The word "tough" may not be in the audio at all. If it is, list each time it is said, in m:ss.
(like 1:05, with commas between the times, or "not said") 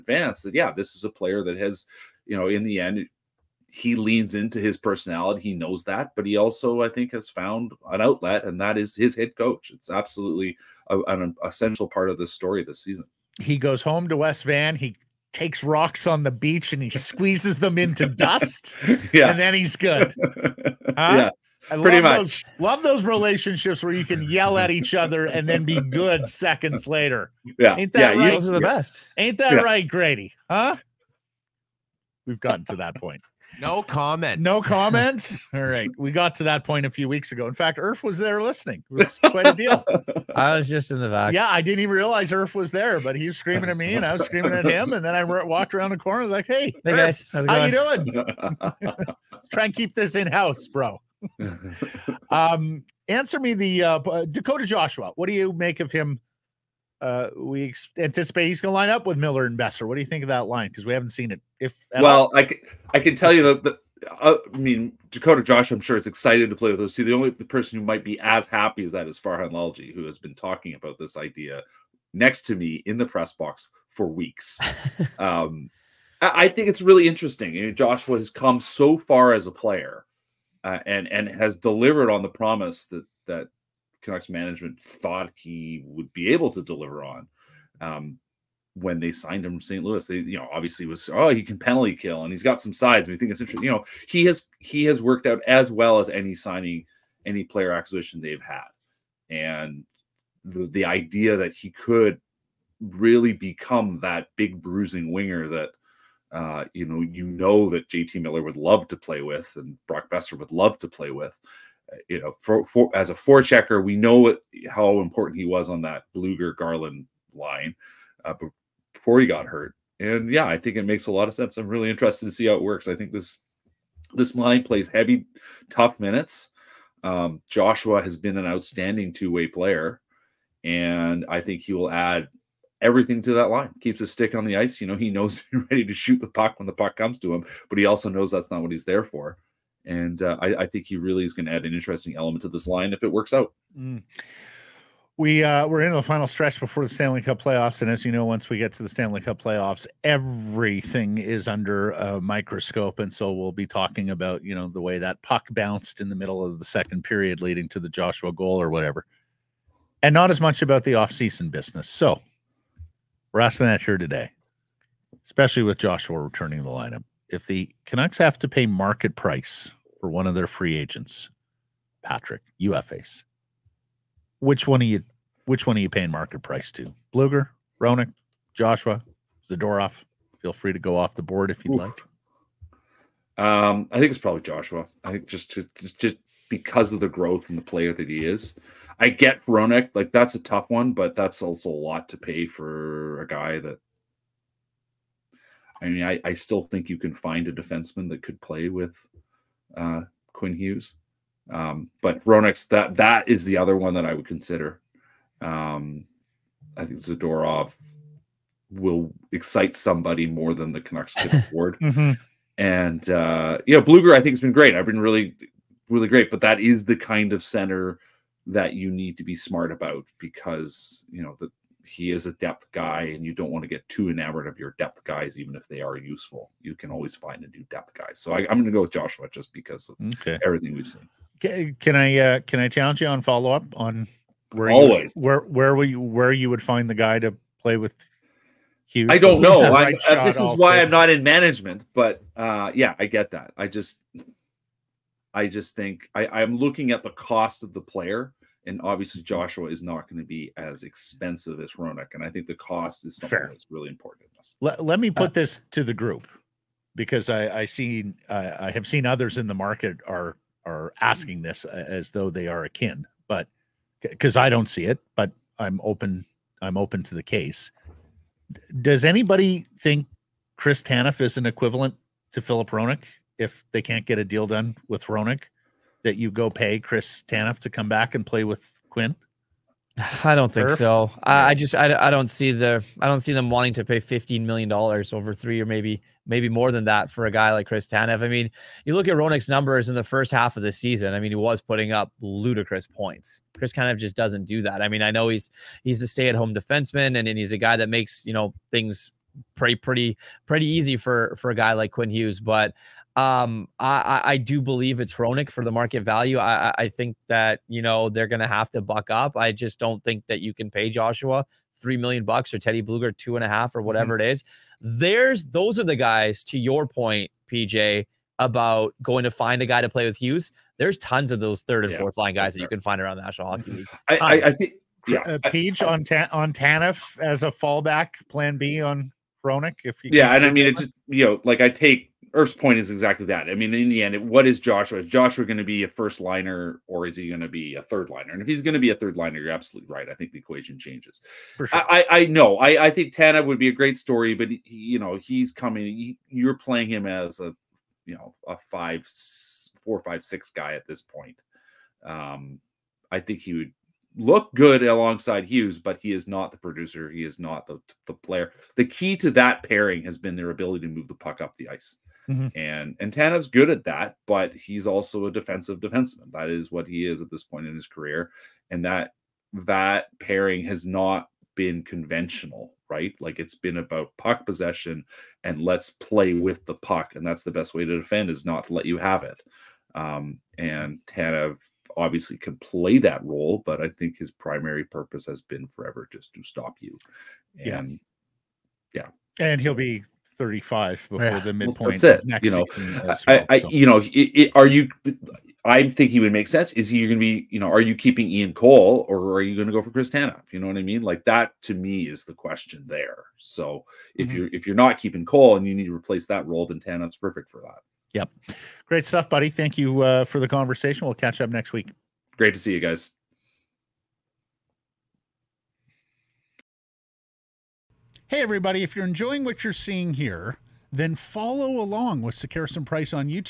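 2:05, 3:10.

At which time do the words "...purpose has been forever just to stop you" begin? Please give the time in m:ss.
6:24.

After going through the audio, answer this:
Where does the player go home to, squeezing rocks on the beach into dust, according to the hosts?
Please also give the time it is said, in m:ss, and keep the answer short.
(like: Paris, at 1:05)
West Van, at 0:14.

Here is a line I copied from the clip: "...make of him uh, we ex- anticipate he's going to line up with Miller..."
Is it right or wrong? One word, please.
right.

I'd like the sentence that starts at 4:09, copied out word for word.
Joshua is not going to be as expensive as Hronek, and I think the cost is something Fair.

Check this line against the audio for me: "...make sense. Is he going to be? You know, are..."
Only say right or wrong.
right.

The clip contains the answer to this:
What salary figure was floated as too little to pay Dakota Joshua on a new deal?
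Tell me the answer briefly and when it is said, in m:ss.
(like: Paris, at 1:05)
3 million, at 5:11.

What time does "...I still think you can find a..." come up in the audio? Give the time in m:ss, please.
3:16.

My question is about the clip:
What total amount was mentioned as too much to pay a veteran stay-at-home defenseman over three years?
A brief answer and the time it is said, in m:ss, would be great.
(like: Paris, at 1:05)
15 million dollars, at 4:43.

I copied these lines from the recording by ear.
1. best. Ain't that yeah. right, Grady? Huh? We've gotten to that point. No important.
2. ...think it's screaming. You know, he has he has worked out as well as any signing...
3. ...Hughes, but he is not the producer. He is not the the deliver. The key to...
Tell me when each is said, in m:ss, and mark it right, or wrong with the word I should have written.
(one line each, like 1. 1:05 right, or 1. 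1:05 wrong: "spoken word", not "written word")
1. 0:28 wrong: "comment", not "important"
2. 1:33 wrong: "interesting", not "screaming"
3. 5:55 wrong: "player", not "deliver".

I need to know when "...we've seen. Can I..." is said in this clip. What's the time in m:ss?
3:50.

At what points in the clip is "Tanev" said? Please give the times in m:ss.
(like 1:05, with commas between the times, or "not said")
4:30, 4:37, 4:47, 5:26, 5:43, 6:03, 6:21, 6:40.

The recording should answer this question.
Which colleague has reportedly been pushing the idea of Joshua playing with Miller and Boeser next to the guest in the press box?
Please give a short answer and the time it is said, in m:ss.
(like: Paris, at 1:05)
Farhan Lalji, at 1:09.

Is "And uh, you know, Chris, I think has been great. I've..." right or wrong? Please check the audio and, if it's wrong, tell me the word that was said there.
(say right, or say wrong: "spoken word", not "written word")
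wrong: "Blueger", not "Chris".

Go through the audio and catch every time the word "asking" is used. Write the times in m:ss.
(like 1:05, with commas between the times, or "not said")
2:43, 4:21.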